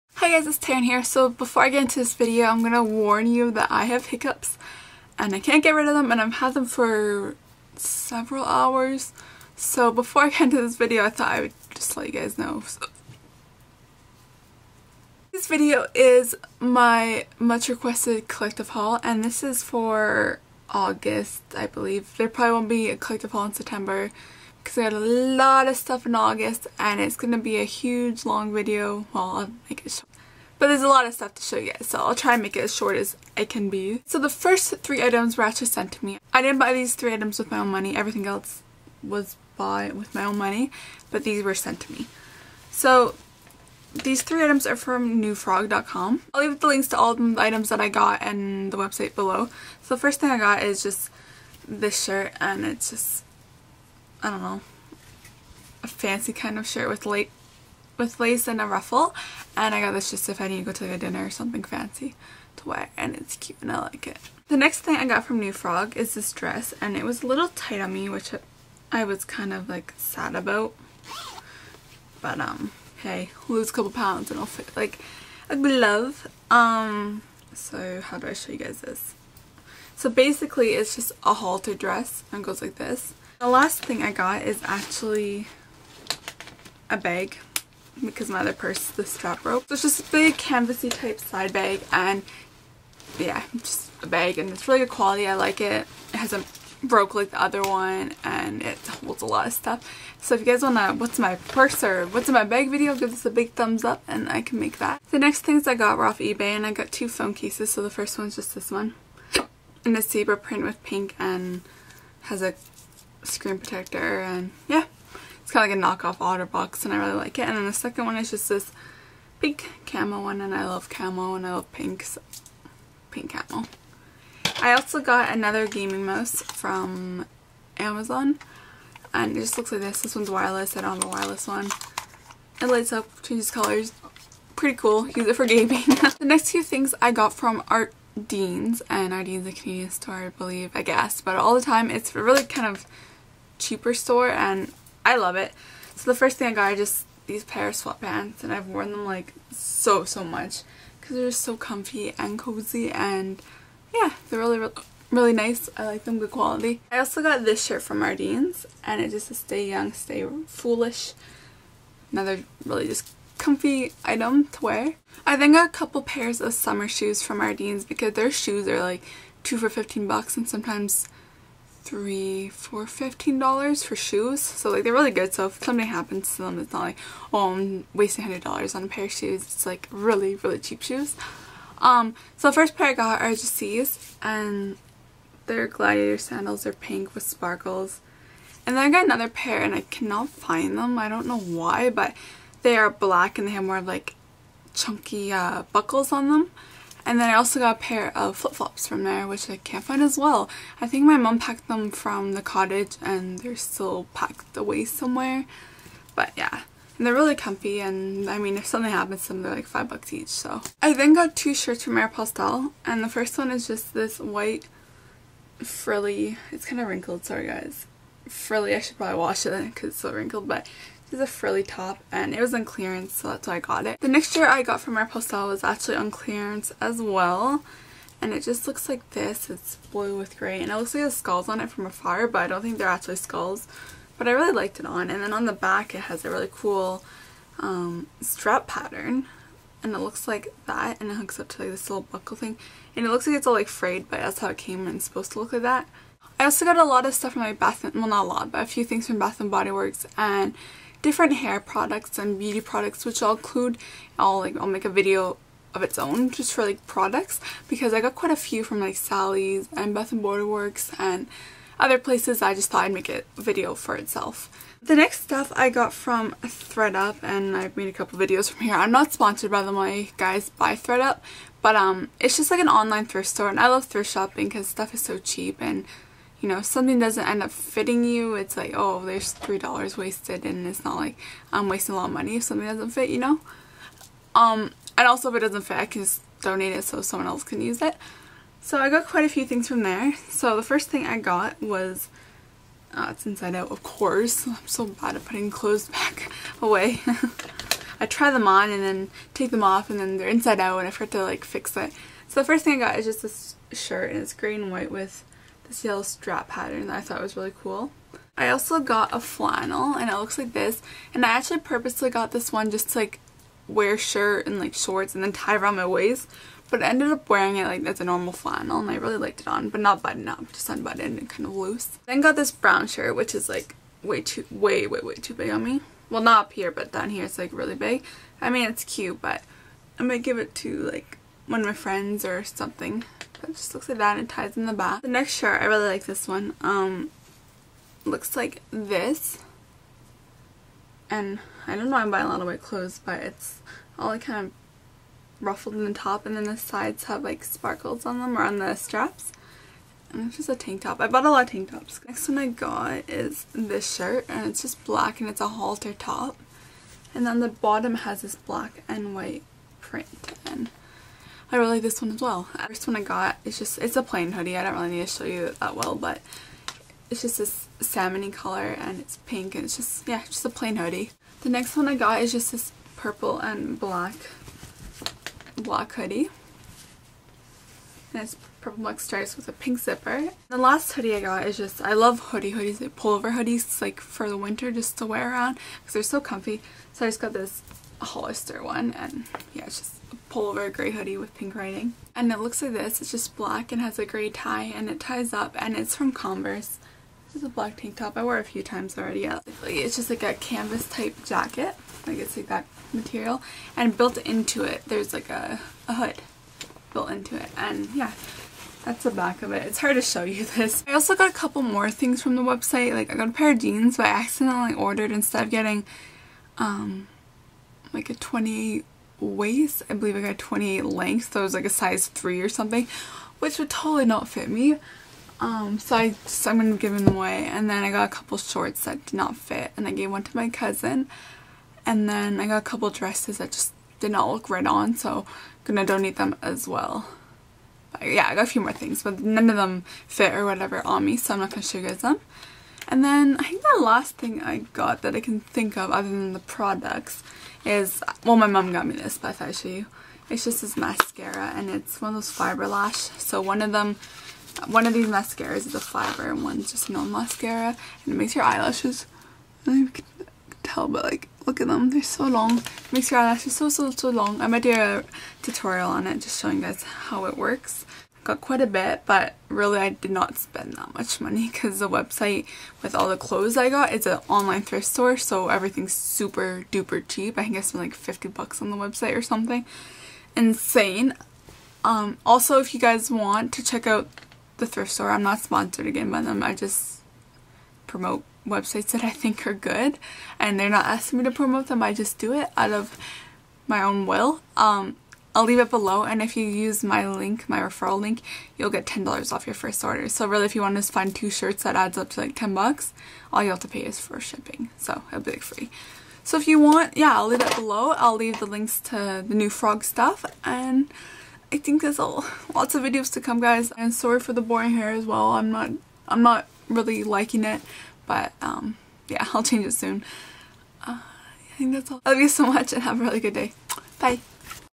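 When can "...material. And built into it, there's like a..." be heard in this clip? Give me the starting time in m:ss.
6:42.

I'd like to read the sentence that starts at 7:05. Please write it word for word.
Um, so I just, I'm going to give them away.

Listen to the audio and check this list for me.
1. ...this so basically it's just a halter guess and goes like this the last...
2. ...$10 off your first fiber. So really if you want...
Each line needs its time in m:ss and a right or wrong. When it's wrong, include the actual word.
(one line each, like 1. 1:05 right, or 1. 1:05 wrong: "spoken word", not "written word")
1. 1:18 wrong: "dress", not "guess"
2. 8:18 wrong: "order", not "fiber".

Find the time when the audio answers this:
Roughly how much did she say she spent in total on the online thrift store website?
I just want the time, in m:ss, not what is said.
7:57.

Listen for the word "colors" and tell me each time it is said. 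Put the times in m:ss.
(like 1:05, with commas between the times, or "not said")
2:13, 6:08.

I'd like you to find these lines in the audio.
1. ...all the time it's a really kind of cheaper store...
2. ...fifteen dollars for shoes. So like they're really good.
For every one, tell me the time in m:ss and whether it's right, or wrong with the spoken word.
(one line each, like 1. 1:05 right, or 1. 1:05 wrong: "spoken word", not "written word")
1. 2:21 right
2. 2:52 right.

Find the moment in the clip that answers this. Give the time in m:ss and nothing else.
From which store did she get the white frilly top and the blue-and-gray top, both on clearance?
3:31.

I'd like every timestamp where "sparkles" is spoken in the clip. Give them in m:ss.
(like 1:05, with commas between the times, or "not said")
3:07, 5:47.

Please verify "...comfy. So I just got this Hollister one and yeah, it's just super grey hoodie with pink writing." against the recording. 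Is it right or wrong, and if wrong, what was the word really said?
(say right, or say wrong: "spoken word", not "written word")
wrong: "pullover", not "super".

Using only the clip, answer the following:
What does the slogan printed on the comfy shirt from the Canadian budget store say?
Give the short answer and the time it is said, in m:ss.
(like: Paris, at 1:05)
stay young, stay foolish, at 2:39.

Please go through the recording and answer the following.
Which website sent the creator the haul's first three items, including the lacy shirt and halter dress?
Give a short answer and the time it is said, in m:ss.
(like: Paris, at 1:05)
newfrog.com, at 0:45.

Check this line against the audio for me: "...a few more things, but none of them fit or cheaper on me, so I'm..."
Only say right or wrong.
wrong.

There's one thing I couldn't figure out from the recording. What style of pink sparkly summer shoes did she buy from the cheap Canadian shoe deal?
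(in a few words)
gladiator sandals.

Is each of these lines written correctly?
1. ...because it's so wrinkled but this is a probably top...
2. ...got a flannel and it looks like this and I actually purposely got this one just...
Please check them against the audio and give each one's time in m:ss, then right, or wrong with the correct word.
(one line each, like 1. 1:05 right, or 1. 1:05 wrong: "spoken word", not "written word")
1. 3:39 wrong: "frilly", not "probably"
2. 5:08 right.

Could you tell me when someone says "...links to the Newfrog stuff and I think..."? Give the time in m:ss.
8:28.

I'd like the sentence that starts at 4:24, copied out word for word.
The next stuff I got from Thredup and I've made a couple videos from here.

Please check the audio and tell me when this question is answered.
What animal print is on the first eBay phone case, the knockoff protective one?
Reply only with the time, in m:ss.
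1:50.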